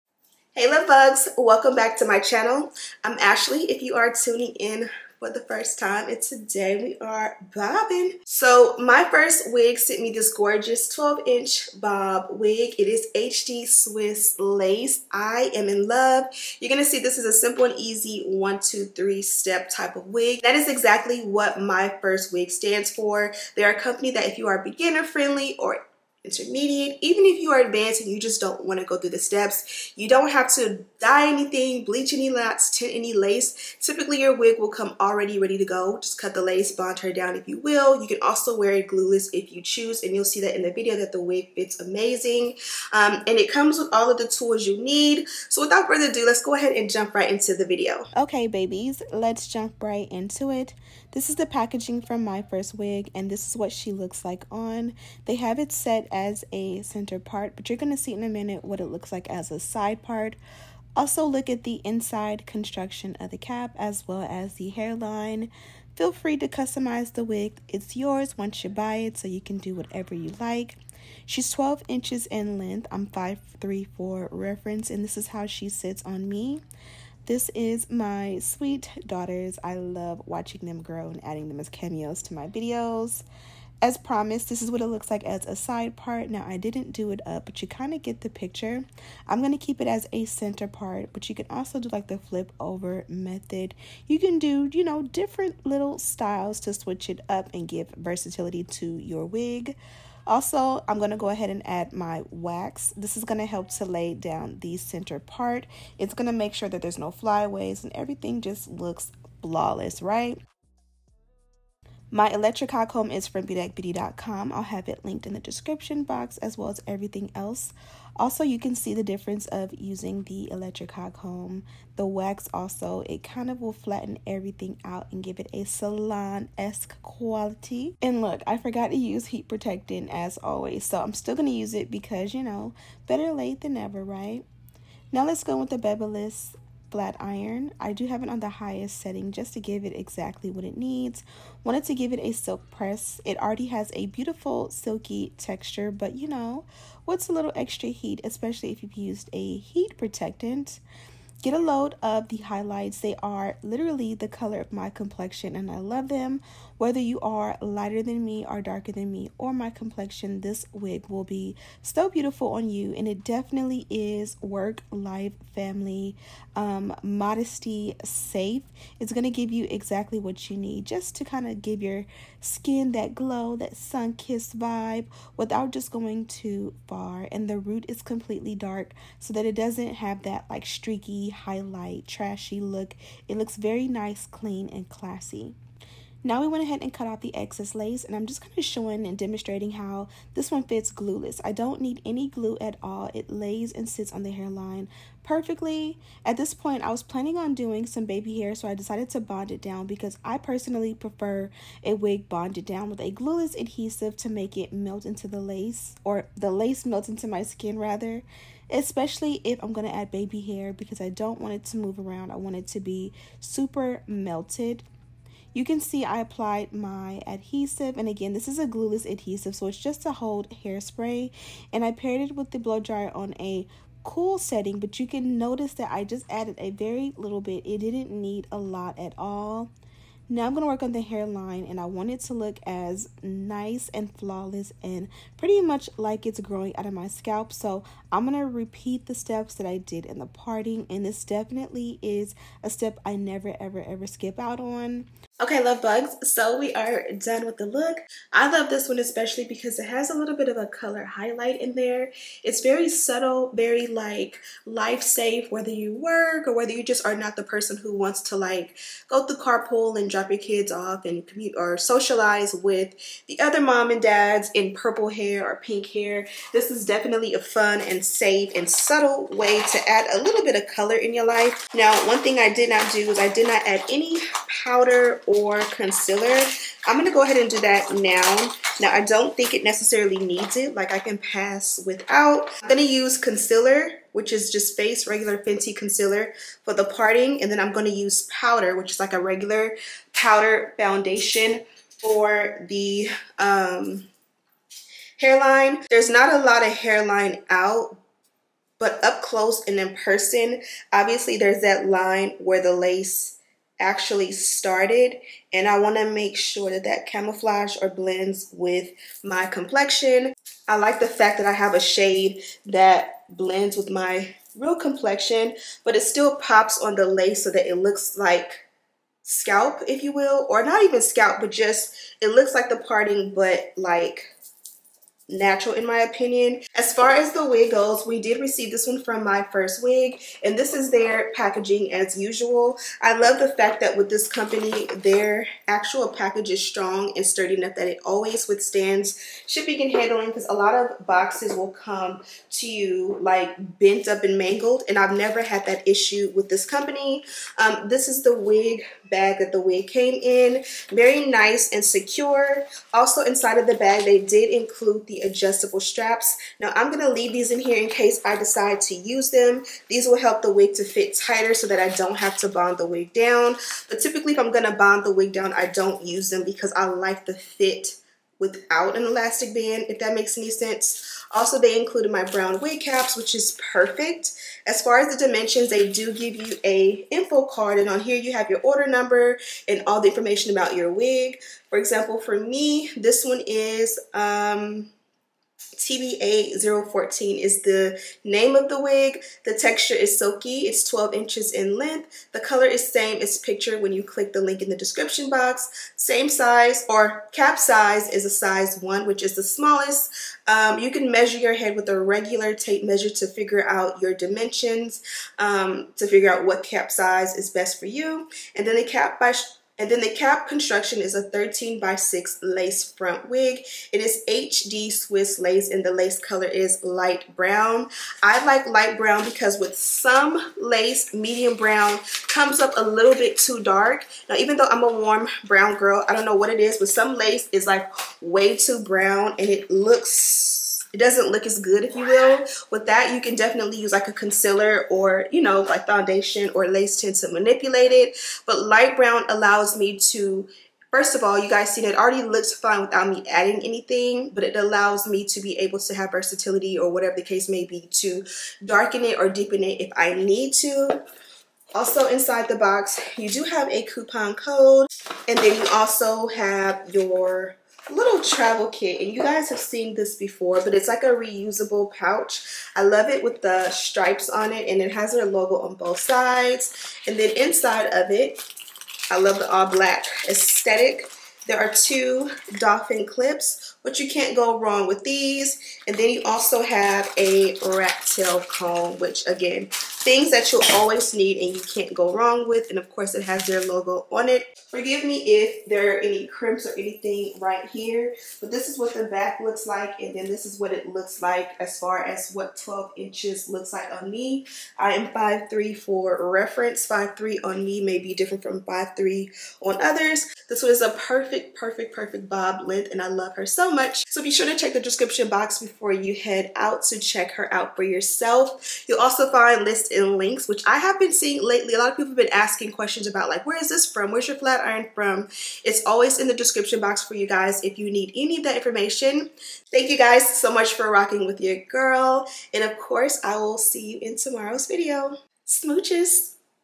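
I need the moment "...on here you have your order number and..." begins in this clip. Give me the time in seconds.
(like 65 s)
377 s.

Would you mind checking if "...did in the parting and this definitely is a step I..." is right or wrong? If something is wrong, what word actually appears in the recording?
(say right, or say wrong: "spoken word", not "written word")
right.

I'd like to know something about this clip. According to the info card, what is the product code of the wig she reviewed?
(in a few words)
TBA014.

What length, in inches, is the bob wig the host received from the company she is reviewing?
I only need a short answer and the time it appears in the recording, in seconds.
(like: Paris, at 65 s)
12, at 10 s.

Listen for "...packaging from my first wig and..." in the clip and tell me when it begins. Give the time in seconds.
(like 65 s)
51 s.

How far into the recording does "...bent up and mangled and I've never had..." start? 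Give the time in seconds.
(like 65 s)
343 s.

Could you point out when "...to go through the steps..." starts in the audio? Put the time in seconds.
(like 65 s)
28 s.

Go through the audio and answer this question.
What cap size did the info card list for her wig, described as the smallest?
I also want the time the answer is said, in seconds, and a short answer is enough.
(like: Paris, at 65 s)
size 1, at 398 s.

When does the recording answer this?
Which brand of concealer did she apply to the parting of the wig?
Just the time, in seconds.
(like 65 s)
285 s.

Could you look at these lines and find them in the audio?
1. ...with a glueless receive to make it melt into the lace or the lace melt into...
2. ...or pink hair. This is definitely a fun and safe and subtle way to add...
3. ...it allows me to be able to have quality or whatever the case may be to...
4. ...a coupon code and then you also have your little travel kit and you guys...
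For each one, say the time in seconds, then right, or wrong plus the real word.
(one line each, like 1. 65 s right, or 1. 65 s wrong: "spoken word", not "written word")
1. 202 s wrong: "adhesive", not "receive"
2. 265 s right
3. 444 s wrong: "versatility", not "quality"
4. 453 s right.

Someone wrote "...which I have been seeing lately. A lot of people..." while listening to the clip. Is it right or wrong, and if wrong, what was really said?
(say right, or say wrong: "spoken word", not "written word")
right.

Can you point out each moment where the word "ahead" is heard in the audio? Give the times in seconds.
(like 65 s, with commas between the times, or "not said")
46 s, 101 s, 186 s, 277 s.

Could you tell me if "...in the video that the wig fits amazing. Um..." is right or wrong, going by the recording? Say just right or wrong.
right.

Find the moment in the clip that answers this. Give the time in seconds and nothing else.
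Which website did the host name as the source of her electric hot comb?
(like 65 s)
113 s.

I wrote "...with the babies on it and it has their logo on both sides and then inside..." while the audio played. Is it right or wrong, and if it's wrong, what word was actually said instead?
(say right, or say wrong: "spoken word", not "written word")
wrong: "stripes", not "babies".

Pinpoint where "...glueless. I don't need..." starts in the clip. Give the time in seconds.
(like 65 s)
190 s.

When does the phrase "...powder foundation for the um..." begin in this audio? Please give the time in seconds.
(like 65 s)
290 s.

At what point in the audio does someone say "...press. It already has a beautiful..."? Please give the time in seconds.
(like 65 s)
142 s.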